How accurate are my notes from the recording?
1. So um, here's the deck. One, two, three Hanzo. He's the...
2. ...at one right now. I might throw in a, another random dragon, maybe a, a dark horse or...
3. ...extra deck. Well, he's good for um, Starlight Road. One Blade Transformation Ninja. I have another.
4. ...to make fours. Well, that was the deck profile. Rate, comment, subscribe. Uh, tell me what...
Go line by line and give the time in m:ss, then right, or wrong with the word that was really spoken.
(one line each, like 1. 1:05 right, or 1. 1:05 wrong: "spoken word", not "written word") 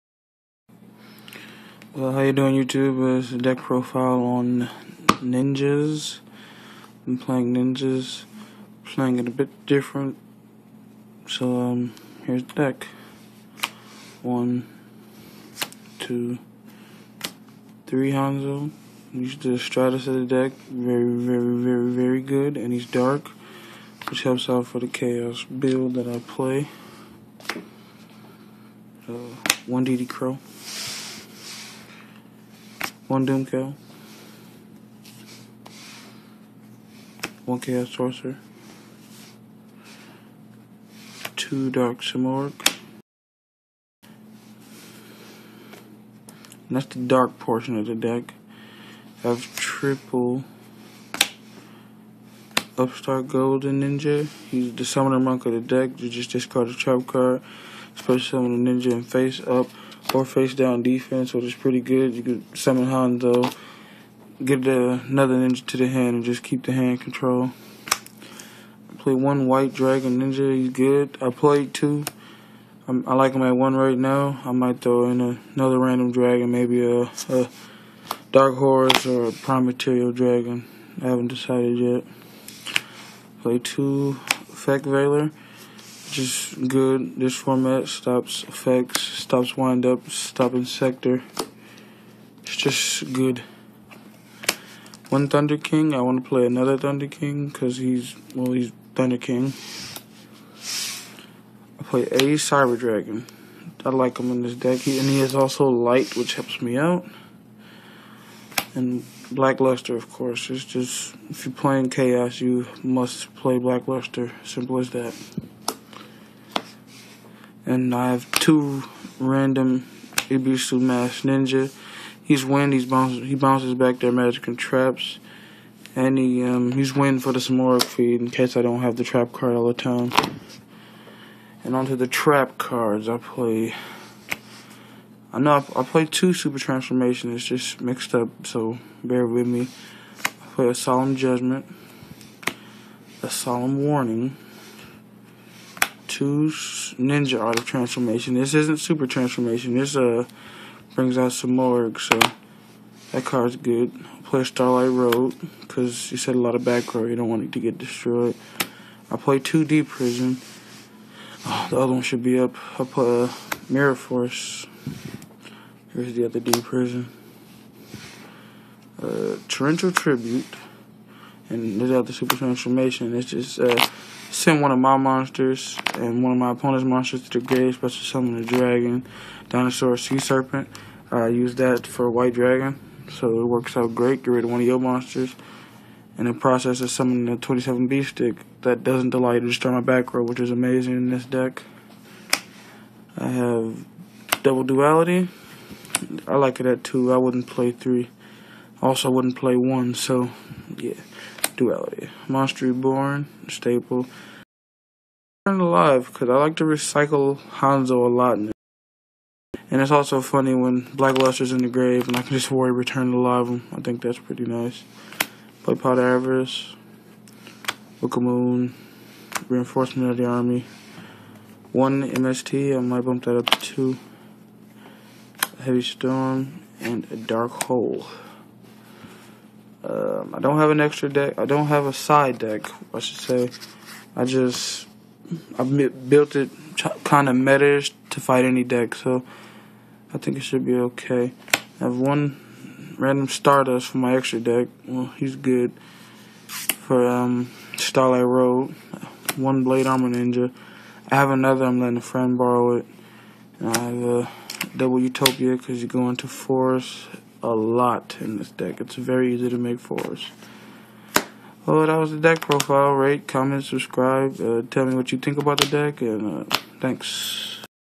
1. 0:11 right
2. 1:13 right
3. 4:04 wrong: "Armor", not "Transformation"
4. 4:19 right.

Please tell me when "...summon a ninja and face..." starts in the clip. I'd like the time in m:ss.
0:58.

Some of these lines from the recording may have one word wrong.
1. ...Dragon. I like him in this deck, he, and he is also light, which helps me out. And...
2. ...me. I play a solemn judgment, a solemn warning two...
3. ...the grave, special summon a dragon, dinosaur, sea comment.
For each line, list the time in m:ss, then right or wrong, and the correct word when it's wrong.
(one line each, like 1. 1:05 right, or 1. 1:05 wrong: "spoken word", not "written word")
1. 1:42 right
2. 2:19 right
3. 2:57 wrong: "serpent", not "comment".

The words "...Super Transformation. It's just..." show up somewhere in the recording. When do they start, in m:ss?
2:52.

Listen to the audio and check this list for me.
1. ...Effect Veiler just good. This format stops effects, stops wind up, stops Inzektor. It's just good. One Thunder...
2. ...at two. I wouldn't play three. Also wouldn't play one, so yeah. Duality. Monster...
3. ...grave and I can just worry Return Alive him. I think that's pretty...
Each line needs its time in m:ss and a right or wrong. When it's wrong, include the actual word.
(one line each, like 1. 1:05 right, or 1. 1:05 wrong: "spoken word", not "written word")
1. 1:24 right
2. 3:16 right
3. 3:31 right.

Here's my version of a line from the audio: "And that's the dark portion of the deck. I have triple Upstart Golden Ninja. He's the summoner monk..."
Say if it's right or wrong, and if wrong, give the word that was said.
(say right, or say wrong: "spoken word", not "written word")
right.